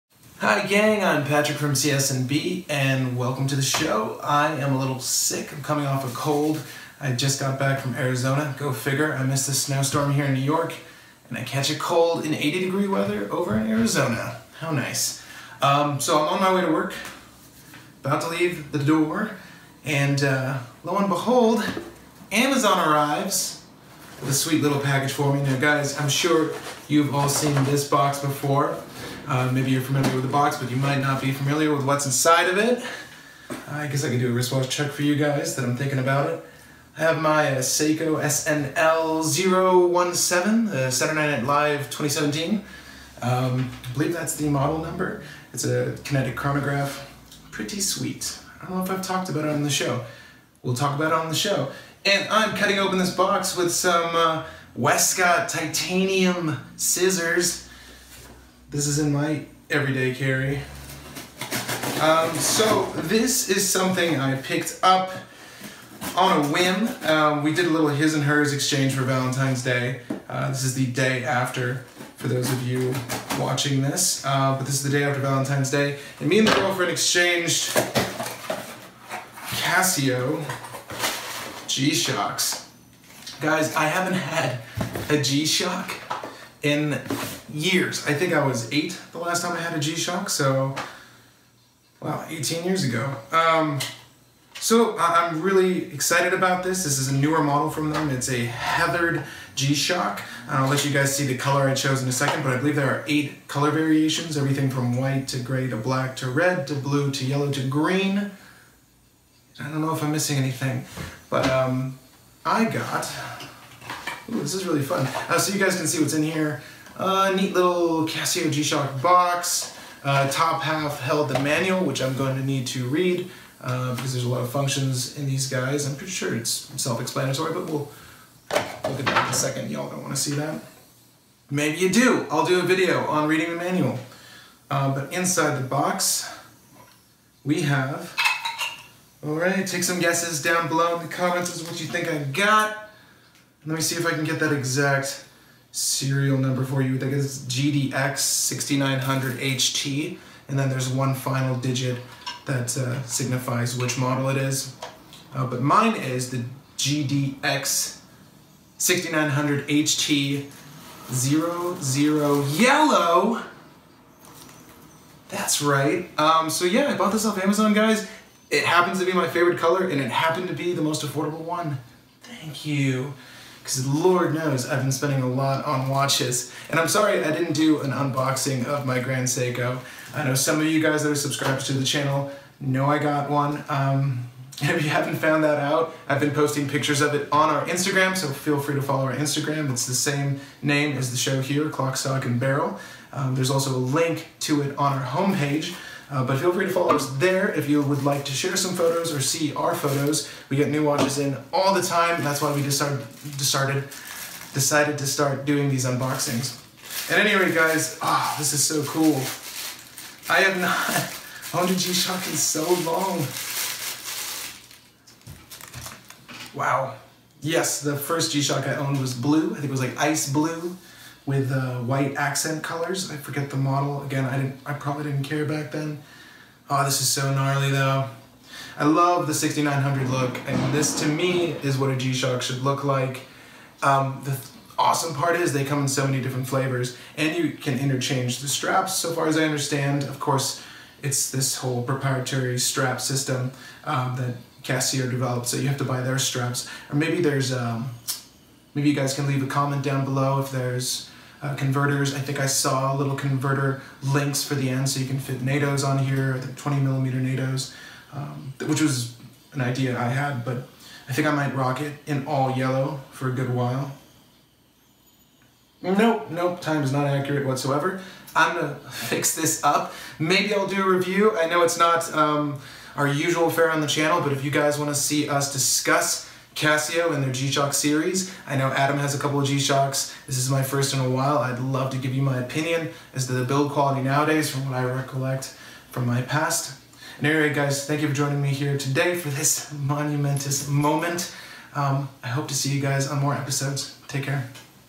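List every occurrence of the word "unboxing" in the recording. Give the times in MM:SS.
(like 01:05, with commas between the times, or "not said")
02:57, 03:25.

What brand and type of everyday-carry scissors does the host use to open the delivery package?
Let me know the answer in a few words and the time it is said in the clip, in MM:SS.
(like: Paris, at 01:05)
Westcott titanium scissors, at 00:54.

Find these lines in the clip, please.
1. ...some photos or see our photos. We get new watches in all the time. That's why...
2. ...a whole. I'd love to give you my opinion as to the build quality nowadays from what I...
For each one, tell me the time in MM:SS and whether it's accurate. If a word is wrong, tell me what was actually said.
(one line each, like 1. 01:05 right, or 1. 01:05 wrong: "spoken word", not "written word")
1. 03:18 right
2. 04:40 wrong: "while", not "whole".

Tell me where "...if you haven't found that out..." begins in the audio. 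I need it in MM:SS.
03:04.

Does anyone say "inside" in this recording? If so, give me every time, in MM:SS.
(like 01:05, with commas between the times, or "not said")
00:32, 02:15.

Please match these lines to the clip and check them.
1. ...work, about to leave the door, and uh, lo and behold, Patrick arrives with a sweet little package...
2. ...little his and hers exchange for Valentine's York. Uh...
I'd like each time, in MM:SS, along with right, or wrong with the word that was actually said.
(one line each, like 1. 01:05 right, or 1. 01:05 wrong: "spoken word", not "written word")
1. 00:16 wrong: "Amazon", not "Patrick"
2. 01:07 wrong: "Day", not "York".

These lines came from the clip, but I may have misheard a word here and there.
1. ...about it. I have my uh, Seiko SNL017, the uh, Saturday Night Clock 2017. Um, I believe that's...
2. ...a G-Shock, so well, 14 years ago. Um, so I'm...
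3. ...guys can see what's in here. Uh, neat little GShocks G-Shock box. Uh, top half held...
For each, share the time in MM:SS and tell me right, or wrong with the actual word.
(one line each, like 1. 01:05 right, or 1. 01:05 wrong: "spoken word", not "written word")
1. 00:35 wrong: "Live", not "Clock"
2. 01:29 wrong: "18", not "14"
3. 01:55 wrong: "Casio", not "GShocks".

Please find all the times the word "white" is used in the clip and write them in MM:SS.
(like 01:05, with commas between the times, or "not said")
01:44, 03:41.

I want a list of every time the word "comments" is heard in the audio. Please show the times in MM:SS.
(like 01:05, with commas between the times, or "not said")
02:21, 04:09.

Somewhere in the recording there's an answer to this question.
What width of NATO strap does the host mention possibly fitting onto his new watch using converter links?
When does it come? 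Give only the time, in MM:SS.
04:16.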